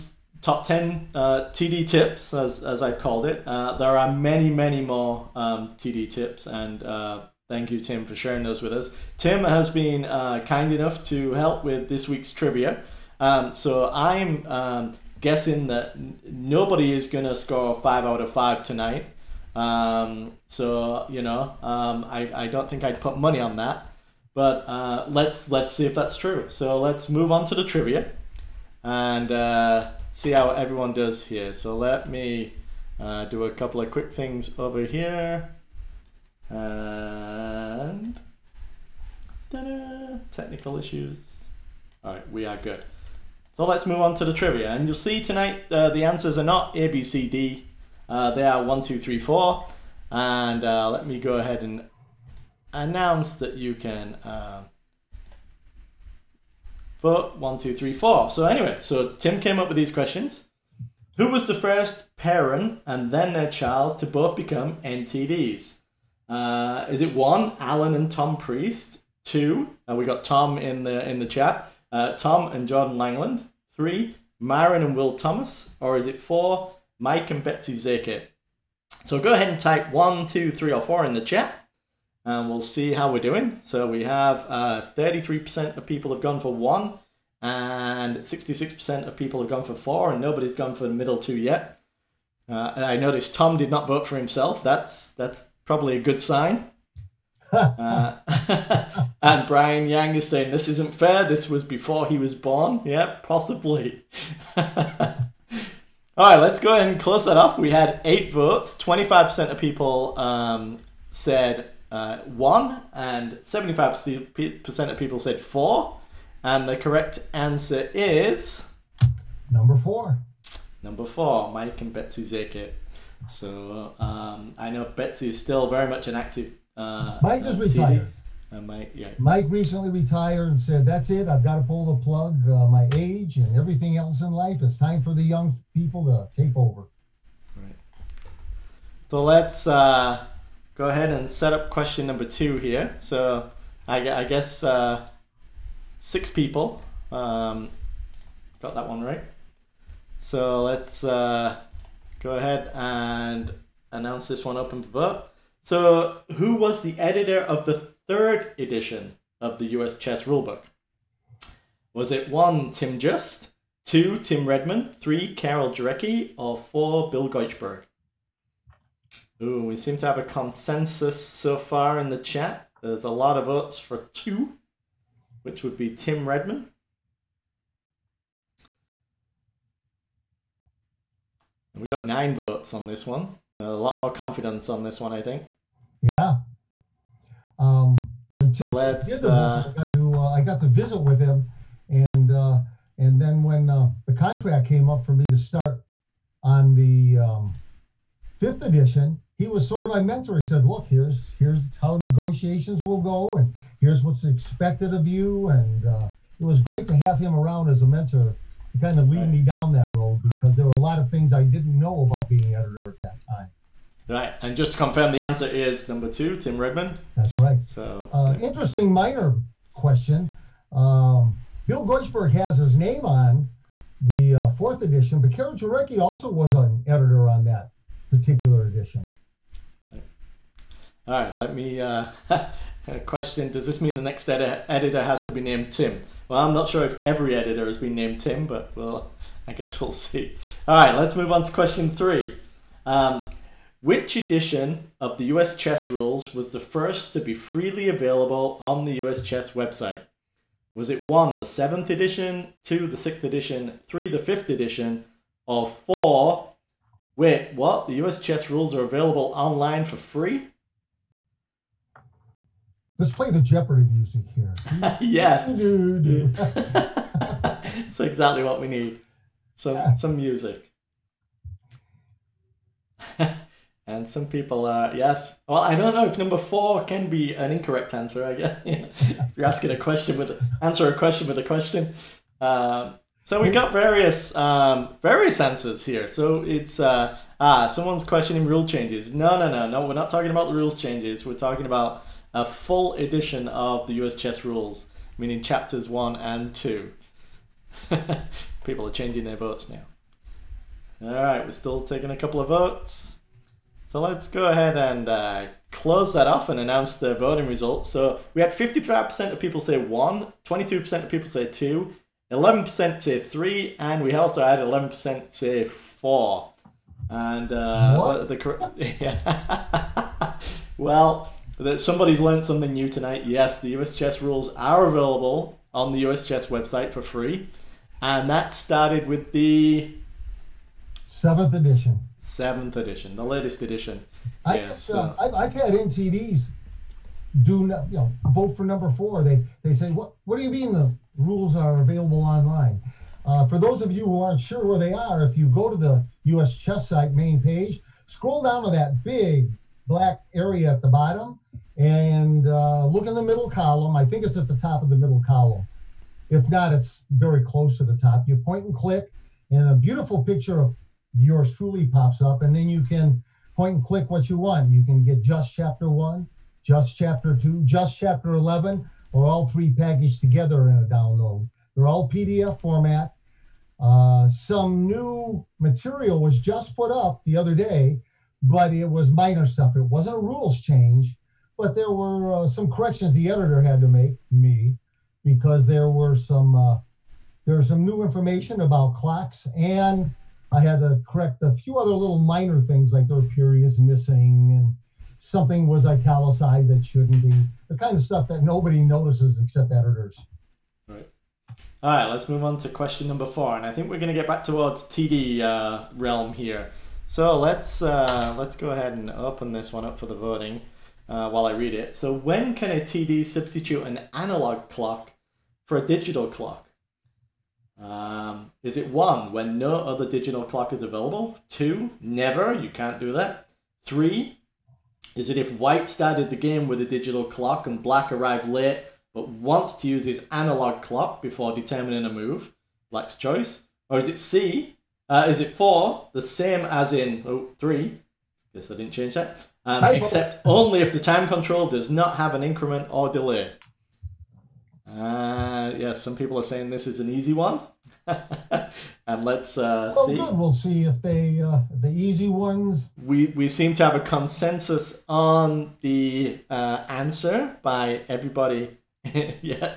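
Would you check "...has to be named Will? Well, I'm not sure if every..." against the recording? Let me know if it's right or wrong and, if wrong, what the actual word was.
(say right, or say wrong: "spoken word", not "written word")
wrong: "Tim", not "Will".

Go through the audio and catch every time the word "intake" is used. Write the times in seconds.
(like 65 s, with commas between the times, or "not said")
not said.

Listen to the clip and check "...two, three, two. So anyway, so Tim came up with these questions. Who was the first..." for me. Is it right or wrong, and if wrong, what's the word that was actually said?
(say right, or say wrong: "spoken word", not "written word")
wrong: "four", not "two".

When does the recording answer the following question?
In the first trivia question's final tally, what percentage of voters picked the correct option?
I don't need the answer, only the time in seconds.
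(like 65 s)
113 s.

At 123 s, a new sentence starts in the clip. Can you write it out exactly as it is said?
So um, I know Betsy is still very much an active.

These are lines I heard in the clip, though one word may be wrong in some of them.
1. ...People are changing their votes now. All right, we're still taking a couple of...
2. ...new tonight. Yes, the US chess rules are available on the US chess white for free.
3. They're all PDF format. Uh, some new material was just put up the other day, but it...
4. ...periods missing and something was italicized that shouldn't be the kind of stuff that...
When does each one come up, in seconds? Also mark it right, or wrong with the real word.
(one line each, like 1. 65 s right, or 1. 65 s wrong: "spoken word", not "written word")
1. 298 s right
2. 322 s wrong: "website", not "white"
3. 371 s right
4. 393 s right.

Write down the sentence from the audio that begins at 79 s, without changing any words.
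So go ahead and type one, two, three, or four in the chat and we'll see how we're doing.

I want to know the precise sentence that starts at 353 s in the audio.
I think it's at the top of the middle column.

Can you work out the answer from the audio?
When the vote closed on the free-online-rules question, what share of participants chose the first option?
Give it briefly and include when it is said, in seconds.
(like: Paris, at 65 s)
55%, at 308 s.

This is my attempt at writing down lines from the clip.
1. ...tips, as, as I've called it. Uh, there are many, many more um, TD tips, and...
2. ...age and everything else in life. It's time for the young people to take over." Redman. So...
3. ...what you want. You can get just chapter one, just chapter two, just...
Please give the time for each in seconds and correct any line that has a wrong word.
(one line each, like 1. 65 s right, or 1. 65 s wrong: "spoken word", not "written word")
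1. 1 s right
2. 132 s wrong: "Right", not "Redman"
3. 364 s right.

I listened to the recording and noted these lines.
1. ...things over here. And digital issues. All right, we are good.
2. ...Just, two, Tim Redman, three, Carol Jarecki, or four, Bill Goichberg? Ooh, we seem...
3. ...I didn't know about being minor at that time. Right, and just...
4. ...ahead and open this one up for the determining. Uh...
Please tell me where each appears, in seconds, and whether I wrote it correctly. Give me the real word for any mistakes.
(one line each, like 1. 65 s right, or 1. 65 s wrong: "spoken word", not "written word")
1. 34 s wrong: "technical", not "digital"
2. 162 s right
3. 211 s wrong: "editor", not "minor"
4. 408 s wrong: "voting", not "determining".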